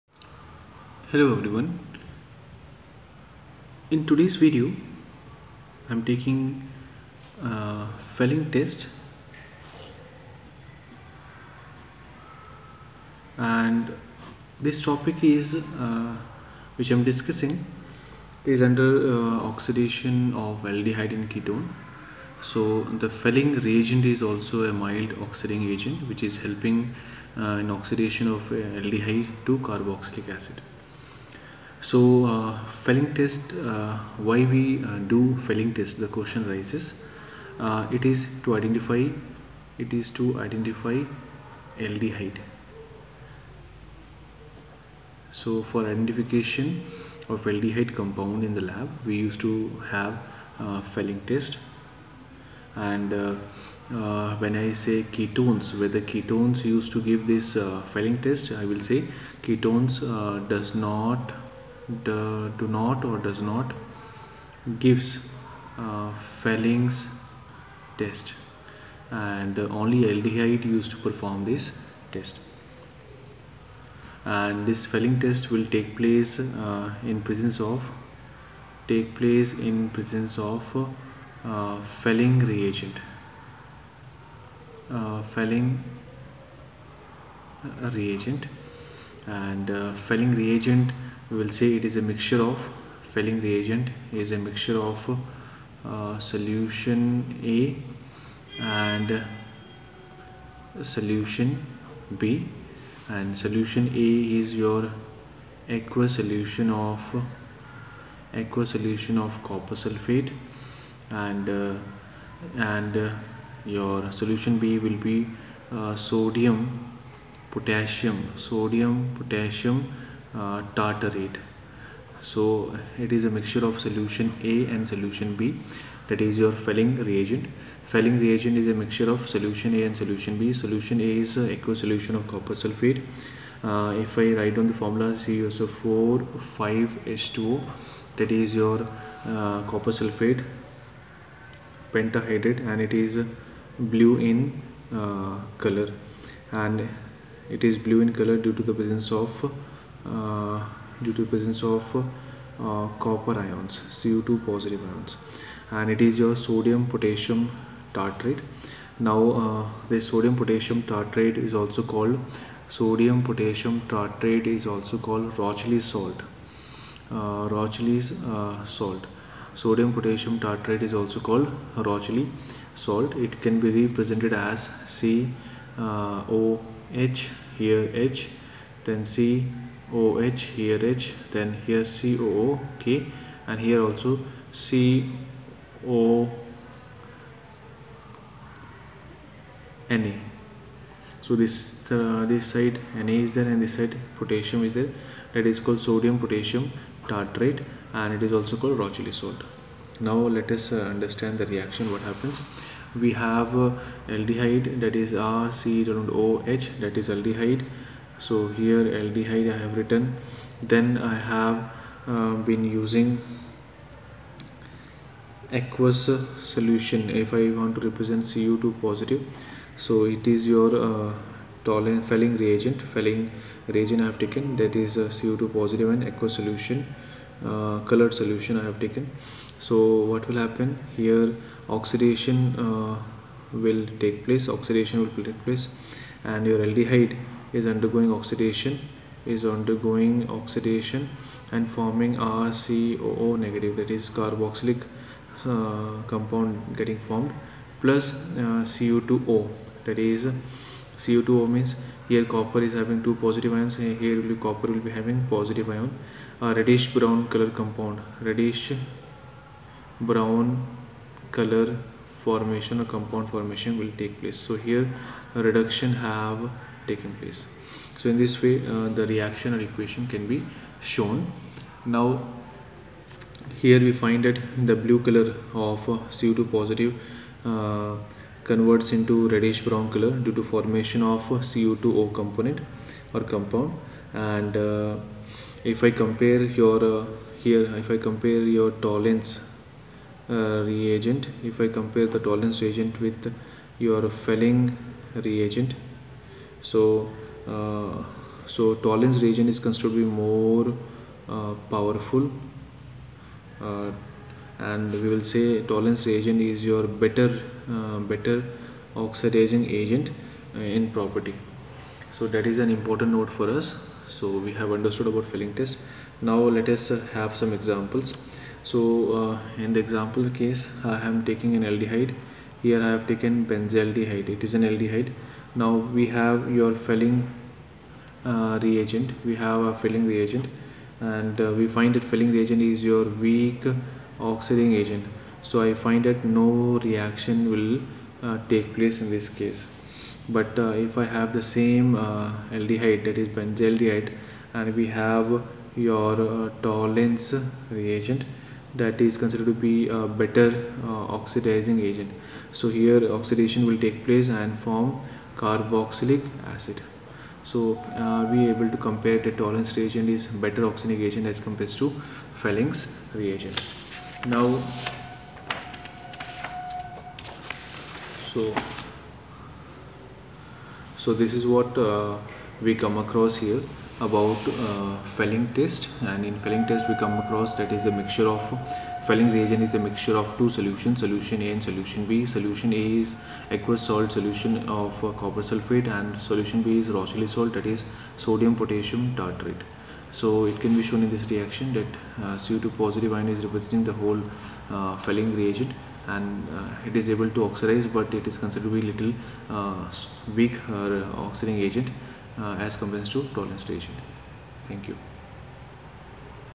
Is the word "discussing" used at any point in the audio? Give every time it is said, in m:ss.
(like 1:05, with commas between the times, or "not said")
0:17.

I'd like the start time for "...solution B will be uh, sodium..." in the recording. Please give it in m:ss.
1:54.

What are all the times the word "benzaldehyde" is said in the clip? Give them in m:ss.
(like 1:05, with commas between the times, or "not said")
5:23, 5:43.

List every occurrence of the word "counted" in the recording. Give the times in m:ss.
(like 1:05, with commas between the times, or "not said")
not said.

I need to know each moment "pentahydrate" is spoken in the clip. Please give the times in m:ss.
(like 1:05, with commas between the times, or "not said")
2:21.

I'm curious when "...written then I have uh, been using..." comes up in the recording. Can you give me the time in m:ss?
3:29.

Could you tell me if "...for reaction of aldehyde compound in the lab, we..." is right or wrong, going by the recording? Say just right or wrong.
wrong.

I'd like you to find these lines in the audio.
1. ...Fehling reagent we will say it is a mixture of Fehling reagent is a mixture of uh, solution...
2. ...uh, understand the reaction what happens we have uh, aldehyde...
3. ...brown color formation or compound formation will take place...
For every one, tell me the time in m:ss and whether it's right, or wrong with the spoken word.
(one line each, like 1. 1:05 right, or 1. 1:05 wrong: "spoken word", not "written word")
1. 1:30 right
2. 3:20 right
3. 4:19 right.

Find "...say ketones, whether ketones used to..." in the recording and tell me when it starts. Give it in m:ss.
0:54.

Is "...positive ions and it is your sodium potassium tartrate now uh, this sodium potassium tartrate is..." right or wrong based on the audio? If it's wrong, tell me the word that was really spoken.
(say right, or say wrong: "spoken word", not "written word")
right.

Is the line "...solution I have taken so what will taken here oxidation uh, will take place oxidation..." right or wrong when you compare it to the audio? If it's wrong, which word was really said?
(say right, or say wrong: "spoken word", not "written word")
wrong: "happen", not "taken".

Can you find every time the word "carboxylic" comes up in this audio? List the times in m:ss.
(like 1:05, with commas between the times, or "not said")
0:29, 4:04, 5:55.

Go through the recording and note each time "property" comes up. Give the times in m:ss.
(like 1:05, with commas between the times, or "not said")
5:10.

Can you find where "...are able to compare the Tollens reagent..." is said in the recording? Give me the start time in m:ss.
5:58.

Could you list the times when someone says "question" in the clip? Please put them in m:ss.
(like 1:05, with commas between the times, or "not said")
0:36.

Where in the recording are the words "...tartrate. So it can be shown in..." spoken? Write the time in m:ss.
6:29.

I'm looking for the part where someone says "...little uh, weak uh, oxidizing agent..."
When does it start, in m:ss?
6:38.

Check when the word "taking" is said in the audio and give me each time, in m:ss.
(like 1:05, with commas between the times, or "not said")
0:06, 5:21.